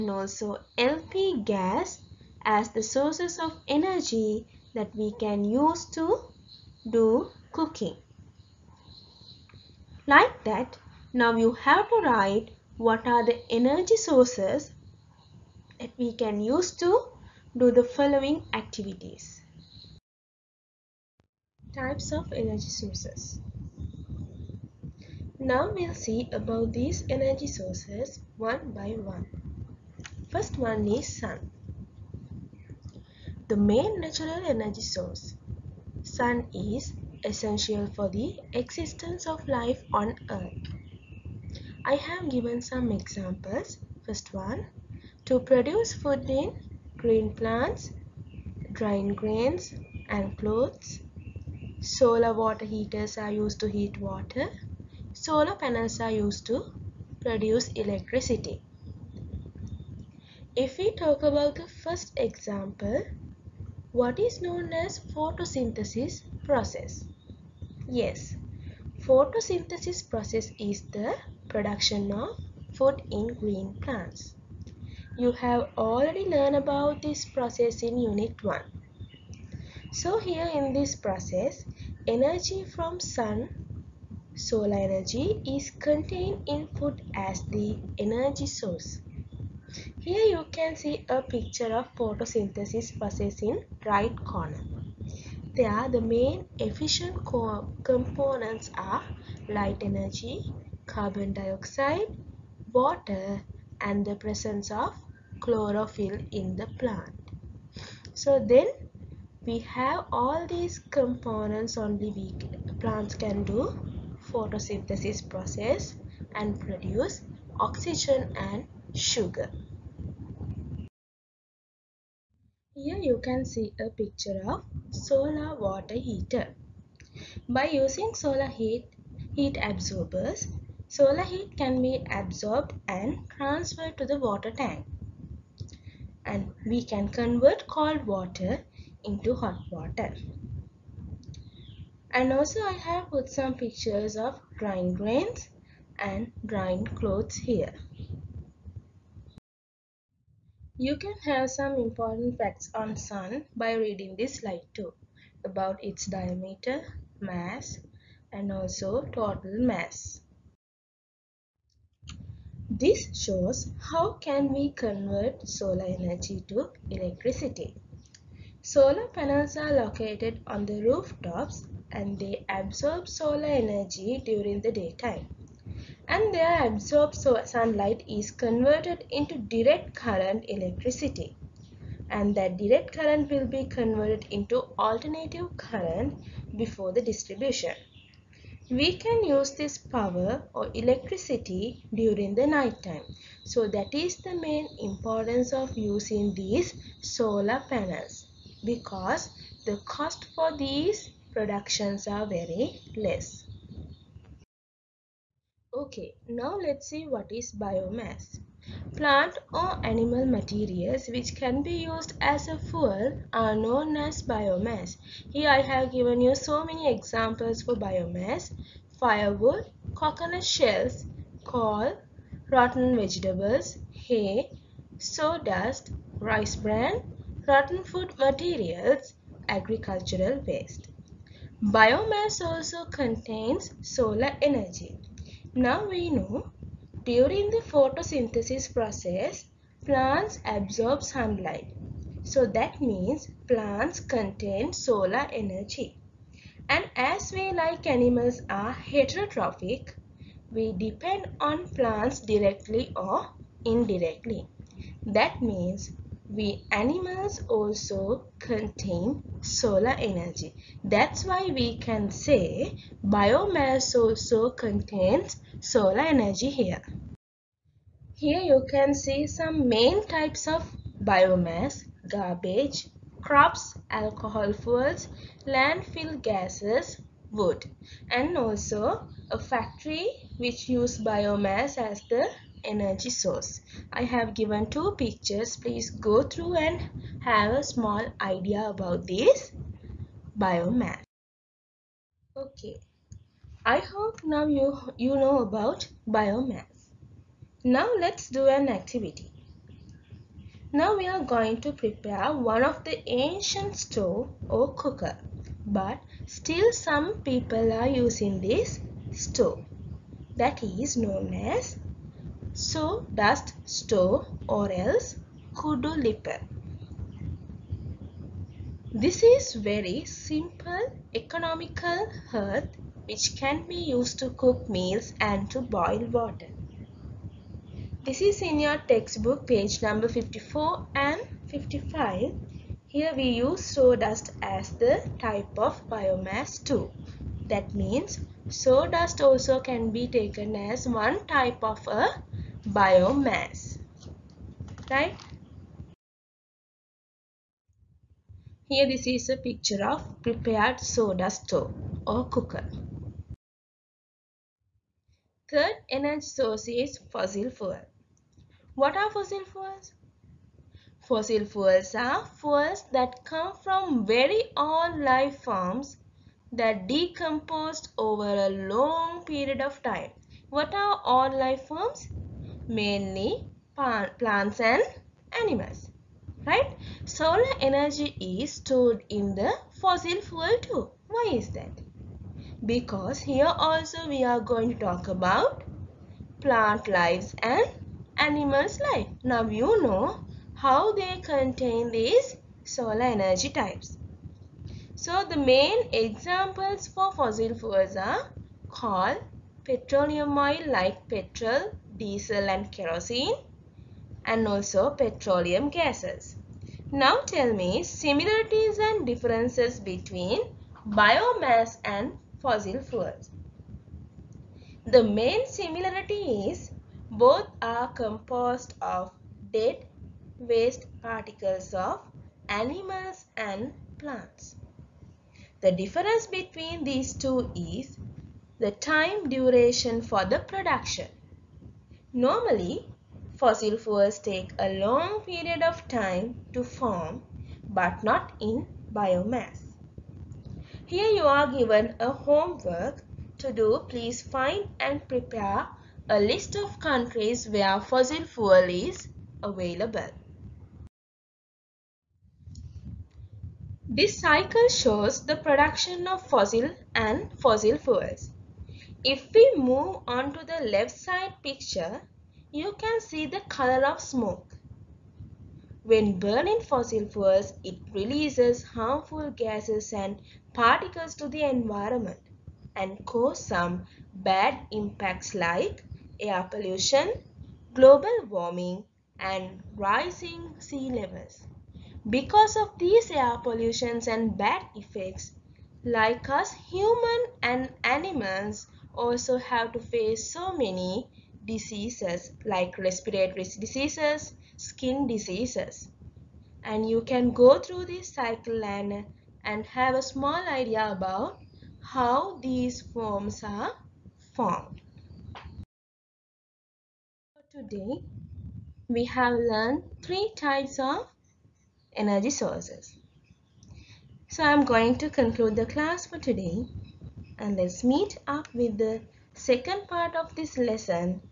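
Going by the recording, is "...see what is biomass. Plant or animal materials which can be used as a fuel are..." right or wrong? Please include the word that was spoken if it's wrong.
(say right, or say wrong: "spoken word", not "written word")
right.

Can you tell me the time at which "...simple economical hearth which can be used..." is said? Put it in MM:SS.
05:20.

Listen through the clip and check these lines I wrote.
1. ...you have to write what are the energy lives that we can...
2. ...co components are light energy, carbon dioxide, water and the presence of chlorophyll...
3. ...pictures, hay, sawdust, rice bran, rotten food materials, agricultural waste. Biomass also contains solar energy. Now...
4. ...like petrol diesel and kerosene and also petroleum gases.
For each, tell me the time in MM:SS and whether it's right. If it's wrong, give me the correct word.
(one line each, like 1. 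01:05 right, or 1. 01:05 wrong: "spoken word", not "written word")
1. 00:11 wrong: "sources", not "lives"
2. 01:37 right
3. 03:42 wrong: "vegetables", not "pictures"
4. 06:40 right.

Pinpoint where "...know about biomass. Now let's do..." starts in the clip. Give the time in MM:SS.
04:55.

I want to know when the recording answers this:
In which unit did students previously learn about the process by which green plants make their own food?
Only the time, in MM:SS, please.
01:17.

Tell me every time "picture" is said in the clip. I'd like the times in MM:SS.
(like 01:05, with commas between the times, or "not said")
01:31, 02:03, 02:23, 04:44, 05:49, 07:41.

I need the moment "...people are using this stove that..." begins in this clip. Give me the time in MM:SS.
05:07.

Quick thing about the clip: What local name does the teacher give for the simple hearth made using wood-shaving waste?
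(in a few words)
kudu.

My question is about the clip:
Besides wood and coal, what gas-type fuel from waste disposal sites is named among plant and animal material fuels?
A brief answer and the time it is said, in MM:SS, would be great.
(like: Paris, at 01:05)
landfill gases, at 04:35.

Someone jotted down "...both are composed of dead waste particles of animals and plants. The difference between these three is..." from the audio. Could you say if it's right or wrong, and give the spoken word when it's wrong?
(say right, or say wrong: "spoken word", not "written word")
wrong: "two", not "three".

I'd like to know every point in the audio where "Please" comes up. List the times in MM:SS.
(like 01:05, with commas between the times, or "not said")
04:45, 07:23.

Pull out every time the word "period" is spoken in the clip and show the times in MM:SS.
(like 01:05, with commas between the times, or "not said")
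06:09, 07:15.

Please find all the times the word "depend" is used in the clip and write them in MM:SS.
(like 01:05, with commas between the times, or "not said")
04:10.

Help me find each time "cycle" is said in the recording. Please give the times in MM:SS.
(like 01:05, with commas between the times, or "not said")
07:34, 08:18.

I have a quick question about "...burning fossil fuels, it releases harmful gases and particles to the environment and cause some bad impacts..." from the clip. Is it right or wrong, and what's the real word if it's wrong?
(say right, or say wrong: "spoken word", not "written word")
right.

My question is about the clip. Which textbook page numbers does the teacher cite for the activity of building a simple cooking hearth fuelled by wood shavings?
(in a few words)
54 and 55.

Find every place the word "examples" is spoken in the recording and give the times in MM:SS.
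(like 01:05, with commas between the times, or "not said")
00:42, 01:02, 03:36, 06:35.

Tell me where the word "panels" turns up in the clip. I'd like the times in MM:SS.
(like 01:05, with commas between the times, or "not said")
00:55, 02:49, 03:17.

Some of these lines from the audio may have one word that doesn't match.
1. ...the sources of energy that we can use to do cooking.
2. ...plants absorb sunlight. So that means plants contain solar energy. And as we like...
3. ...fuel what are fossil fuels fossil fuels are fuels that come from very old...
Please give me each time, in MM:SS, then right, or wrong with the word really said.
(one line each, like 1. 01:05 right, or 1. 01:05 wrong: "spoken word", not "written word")
1. 00:02 right
2. 03:59 right
3. 05:57 right.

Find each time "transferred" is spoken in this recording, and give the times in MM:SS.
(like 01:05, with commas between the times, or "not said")
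02:13.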